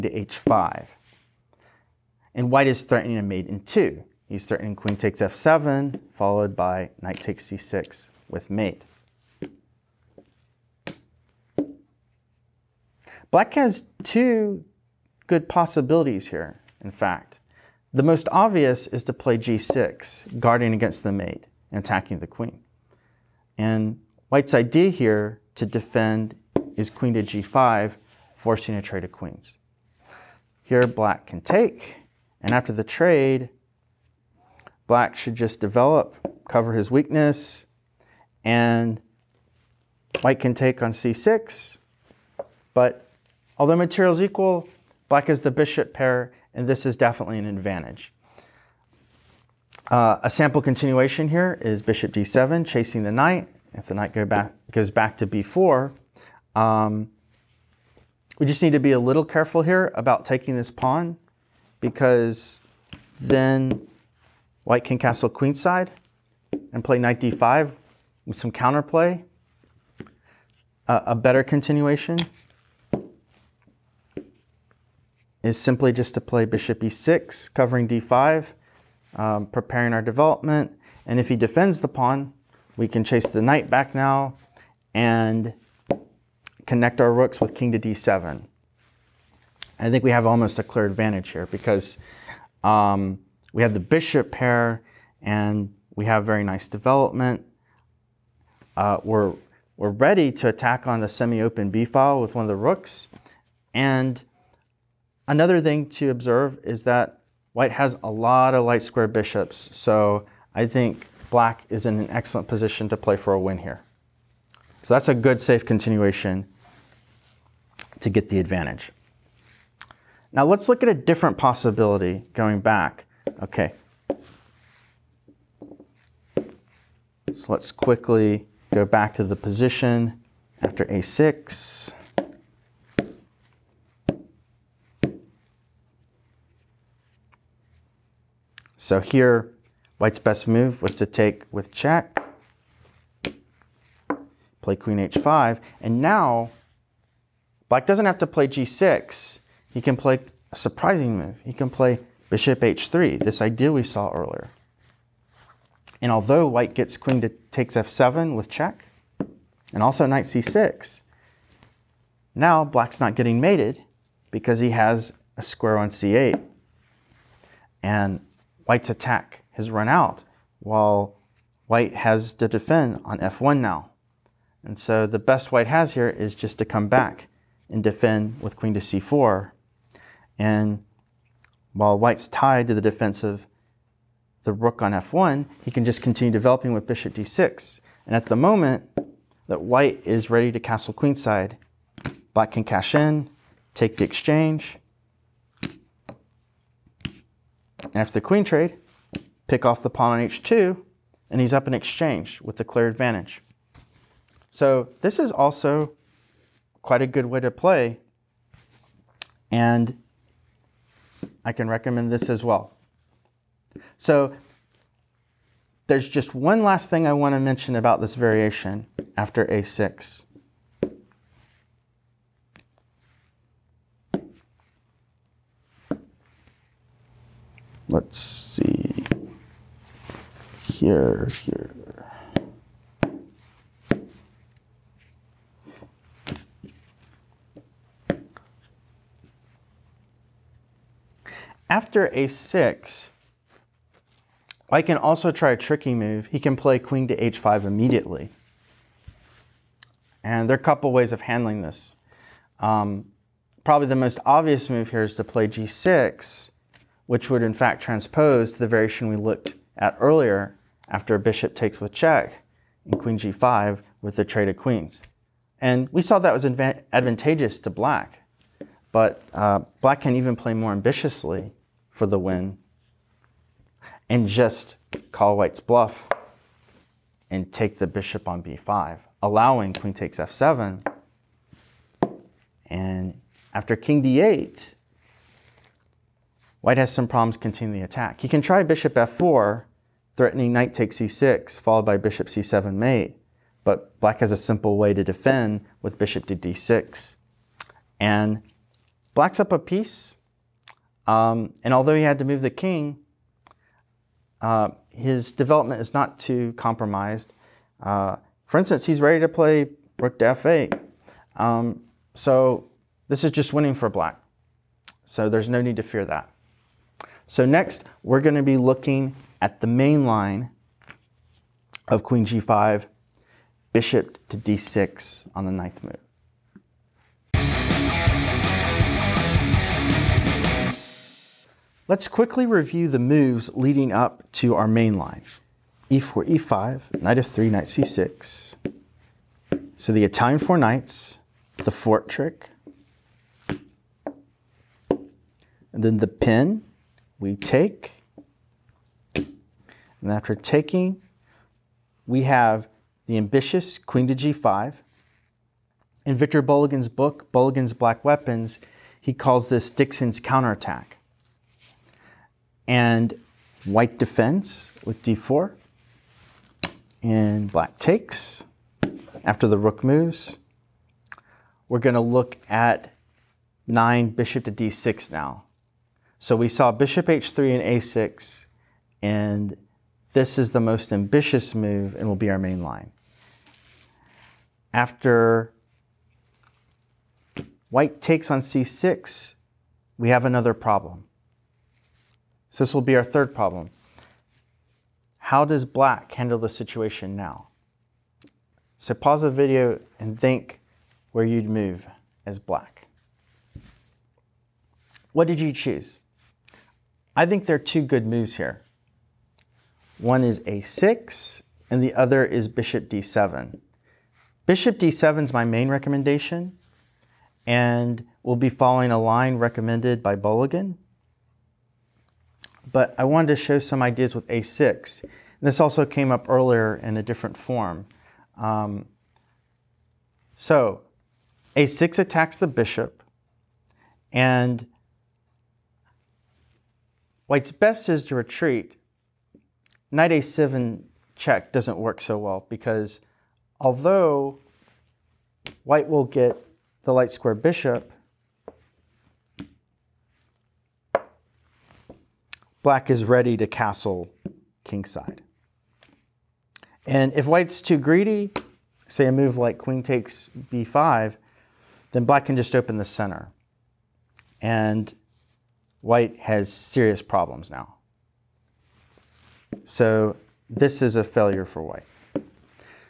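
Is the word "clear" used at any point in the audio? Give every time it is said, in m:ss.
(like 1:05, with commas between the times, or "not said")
1:30, 3:22.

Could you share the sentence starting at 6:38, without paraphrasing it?
So pause the video and think where you'd move as black.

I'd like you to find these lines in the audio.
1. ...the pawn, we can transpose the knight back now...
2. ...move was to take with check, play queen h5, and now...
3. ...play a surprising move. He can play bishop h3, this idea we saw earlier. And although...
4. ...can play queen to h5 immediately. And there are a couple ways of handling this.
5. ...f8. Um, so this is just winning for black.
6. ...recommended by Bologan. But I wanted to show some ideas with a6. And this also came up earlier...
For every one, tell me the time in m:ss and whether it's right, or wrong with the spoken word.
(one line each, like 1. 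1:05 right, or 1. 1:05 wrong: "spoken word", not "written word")
1. 1:21 wrong: "chase", not "transpose"
2. 2:20 right
3. 2:29 right
4. 4:06 right
5. 5:10 right
6. 6:59 right.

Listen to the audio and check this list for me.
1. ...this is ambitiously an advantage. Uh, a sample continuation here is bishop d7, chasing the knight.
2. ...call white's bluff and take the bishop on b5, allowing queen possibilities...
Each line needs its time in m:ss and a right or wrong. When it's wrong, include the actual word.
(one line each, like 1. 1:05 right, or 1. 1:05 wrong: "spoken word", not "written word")
1. 0:46 wrong: "definitely", not "ambitiously"
2. 4:35 wrong: "takes", not "possibilities".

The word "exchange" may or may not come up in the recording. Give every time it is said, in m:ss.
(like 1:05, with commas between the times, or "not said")
3:14, 3:21.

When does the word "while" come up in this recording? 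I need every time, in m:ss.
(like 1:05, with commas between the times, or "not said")
2:50, 3:01.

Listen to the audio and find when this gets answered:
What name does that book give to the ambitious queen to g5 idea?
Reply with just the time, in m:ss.
5:59.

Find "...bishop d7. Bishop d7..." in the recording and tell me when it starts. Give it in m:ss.
6:52.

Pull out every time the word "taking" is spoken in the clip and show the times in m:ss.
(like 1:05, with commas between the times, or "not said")
1:00, 5:50.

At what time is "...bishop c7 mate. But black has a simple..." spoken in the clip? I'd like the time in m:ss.
4:51.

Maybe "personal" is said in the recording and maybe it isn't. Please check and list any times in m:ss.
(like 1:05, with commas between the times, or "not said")
not said.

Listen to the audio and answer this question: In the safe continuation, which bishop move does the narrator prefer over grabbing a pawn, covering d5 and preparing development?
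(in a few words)
bishop e6.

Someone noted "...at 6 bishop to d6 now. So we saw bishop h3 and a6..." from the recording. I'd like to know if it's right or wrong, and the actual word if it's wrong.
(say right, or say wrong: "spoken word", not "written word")
wrong: "9", not "6".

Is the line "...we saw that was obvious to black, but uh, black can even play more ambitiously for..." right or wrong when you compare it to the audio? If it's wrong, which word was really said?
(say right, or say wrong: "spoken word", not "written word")
wrong: "advantageous", not "obvious".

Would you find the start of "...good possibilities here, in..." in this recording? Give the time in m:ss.
0:15.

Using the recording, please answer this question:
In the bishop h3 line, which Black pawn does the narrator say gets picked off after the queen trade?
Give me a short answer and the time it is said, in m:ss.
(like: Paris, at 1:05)
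h2, at 3:20.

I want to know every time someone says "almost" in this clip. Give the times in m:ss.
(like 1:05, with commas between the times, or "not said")
1:30.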